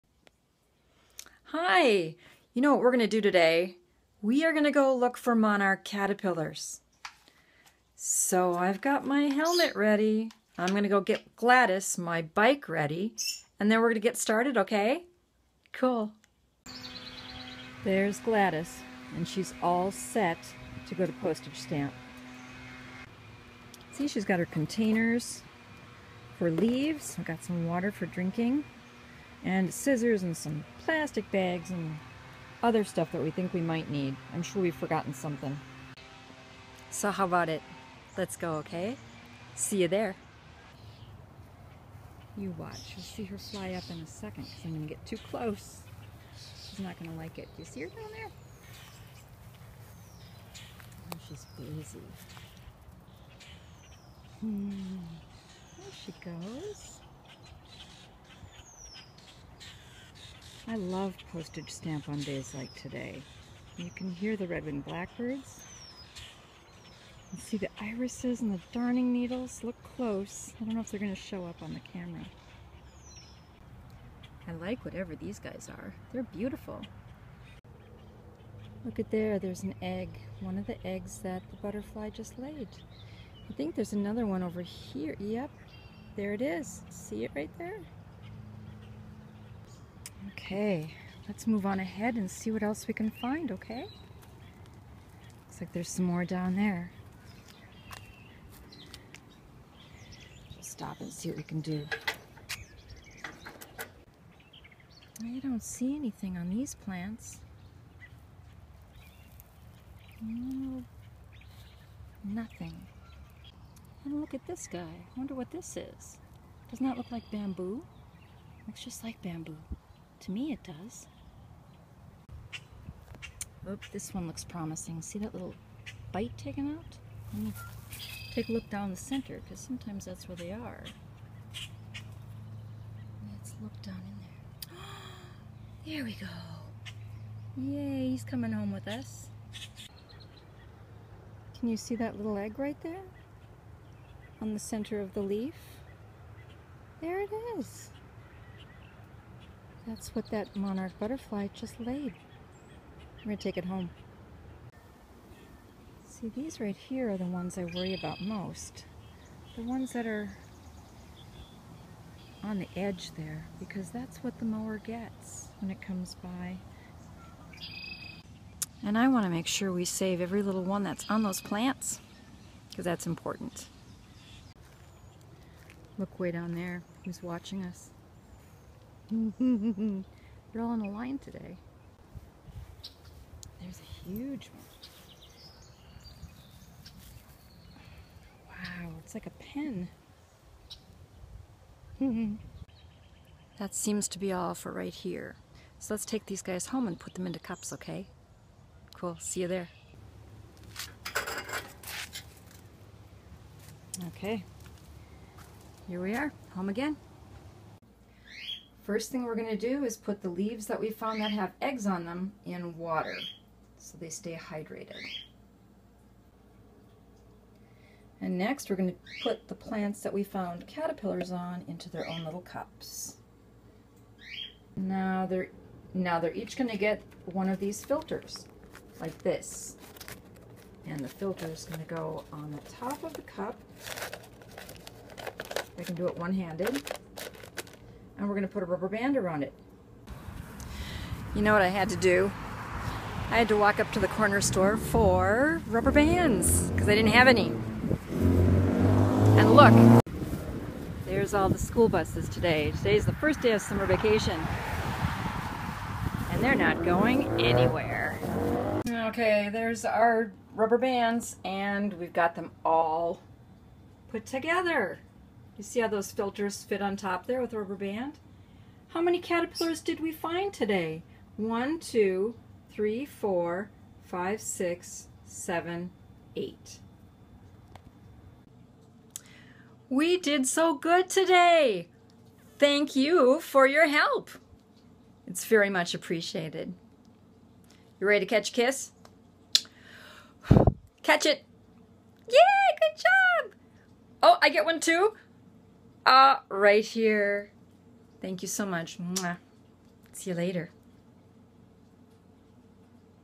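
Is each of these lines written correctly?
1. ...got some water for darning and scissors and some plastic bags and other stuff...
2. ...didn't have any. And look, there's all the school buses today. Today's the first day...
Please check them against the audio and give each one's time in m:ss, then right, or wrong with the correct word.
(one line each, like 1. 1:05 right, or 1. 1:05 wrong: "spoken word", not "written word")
1. 0:27 wrong: "drinking", not "darning"
2. 4:06 right.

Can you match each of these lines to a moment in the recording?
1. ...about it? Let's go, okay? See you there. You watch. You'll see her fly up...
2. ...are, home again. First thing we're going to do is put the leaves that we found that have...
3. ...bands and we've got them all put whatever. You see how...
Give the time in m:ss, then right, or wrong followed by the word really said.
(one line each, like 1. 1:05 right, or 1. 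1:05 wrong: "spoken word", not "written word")
1. 0:37 right
2. 3:26 right
3. 4:20 wrong: "together", not "whatever".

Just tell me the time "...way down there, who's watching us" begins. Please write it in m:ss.
2:56.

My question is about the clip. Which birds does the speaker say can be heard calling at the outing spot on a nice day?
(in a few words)
red-winged blackbirds.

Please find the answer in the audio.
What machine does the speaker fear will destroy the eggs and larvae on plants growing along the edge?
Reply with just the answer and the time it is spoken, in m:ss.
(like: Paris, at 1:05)
the mower, at 2:44.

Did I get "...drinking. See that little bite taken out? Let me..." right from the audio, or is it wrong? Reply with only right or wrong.
wrong.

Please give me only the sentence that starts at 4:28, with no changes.
How many caterpillars did we find today?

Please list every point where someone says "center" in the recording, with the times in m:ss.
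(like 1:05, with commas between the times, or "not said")
2:08, 2:24.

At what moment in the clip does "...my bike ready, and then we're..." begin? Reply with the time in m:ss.
0:11.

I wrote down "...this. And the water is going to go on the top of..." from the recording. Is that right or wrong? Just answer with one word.
wrong.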